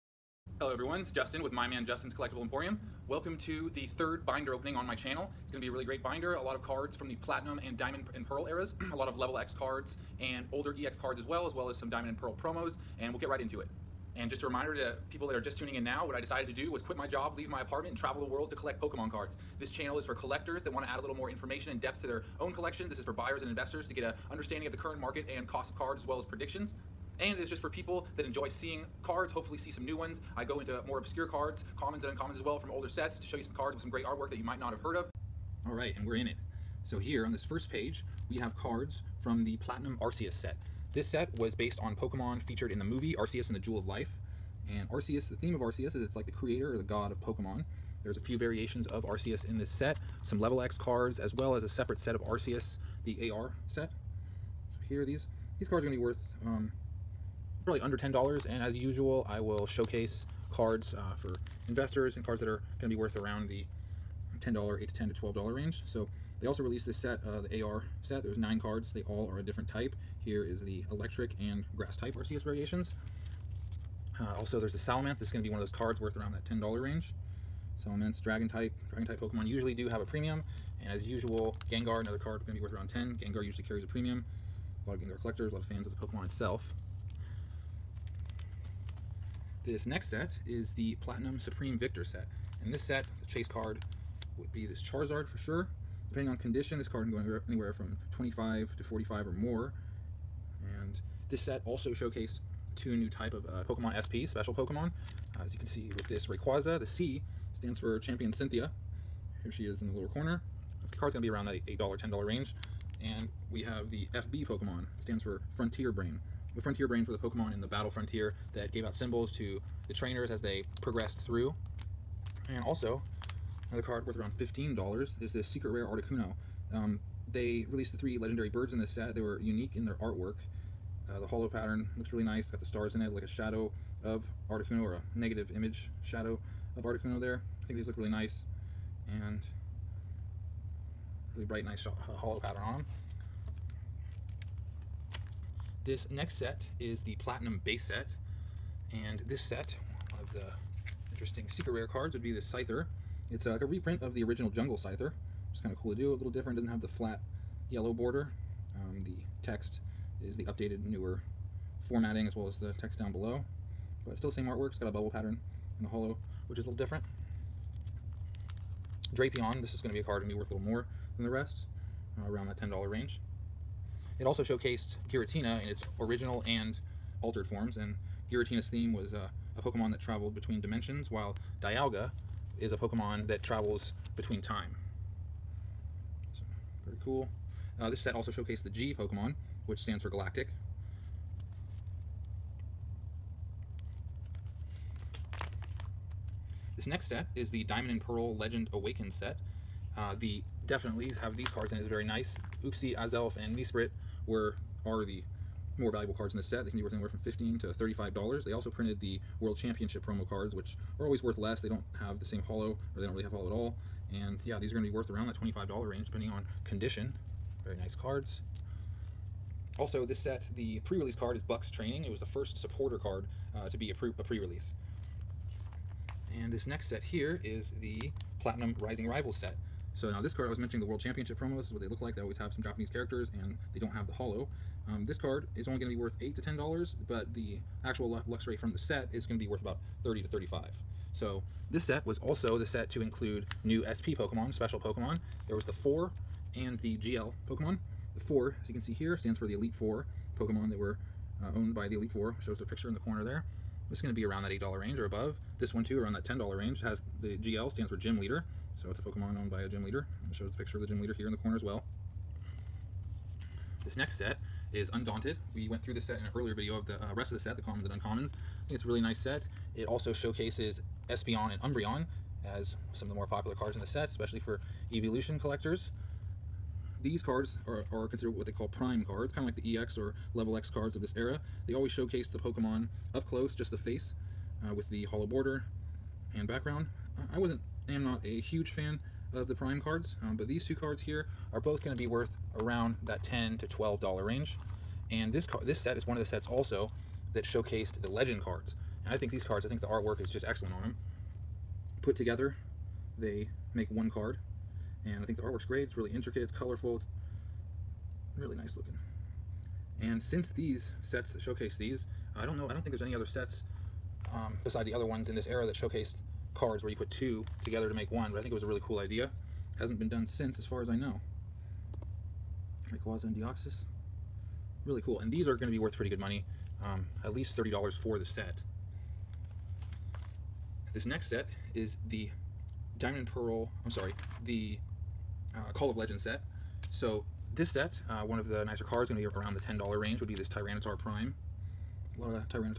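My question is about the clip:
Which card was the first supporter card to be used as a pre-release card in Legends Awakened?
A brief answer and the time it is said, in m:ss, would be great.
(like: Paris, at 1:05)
Buck's Training, at 3:41.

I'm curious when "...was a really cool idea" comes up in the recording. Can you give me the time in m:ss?
5:18.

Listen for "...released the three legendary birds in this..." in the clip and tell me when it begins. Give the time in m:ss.
2:07.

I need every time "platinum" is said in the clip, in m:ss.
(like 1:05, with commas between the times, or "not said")
0:07, 0:39, 1:31, 2:27, 3:48.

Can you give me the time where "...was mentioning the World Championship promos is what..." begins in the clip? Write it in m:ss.
3:50.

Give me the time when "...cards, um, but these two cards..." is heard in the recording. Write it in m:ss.
4:49.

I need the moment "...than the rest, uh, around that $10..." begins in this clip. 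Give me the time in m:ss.
2:51.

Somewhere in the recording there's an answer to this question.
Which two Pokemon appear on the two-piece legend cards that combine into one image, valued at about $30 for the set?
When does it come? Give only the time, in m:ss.
5:23.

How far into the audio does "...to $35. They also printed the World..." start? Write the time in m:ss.
3:27.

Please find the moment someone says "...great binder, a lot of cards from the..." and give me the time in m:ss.
0:05.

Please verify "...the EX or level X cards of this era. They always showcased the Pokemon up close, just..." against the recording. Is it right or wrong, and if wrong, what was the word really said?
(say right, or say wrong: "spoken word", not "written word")
right.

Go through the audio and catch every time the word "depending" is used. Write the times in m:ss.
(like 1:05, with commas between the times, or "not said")
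1:36, 3:36.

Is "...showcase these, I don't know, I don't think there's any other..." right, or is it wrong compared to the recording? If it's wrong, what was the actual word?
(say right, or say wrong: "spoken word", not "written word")
right.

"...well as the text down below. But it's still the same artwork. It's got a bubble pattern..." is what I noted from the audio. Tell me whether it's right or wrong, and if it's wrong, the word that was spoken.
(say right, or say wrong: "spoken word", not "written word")
right.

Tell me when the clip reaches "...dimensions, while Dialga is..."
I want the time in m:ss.
3:00.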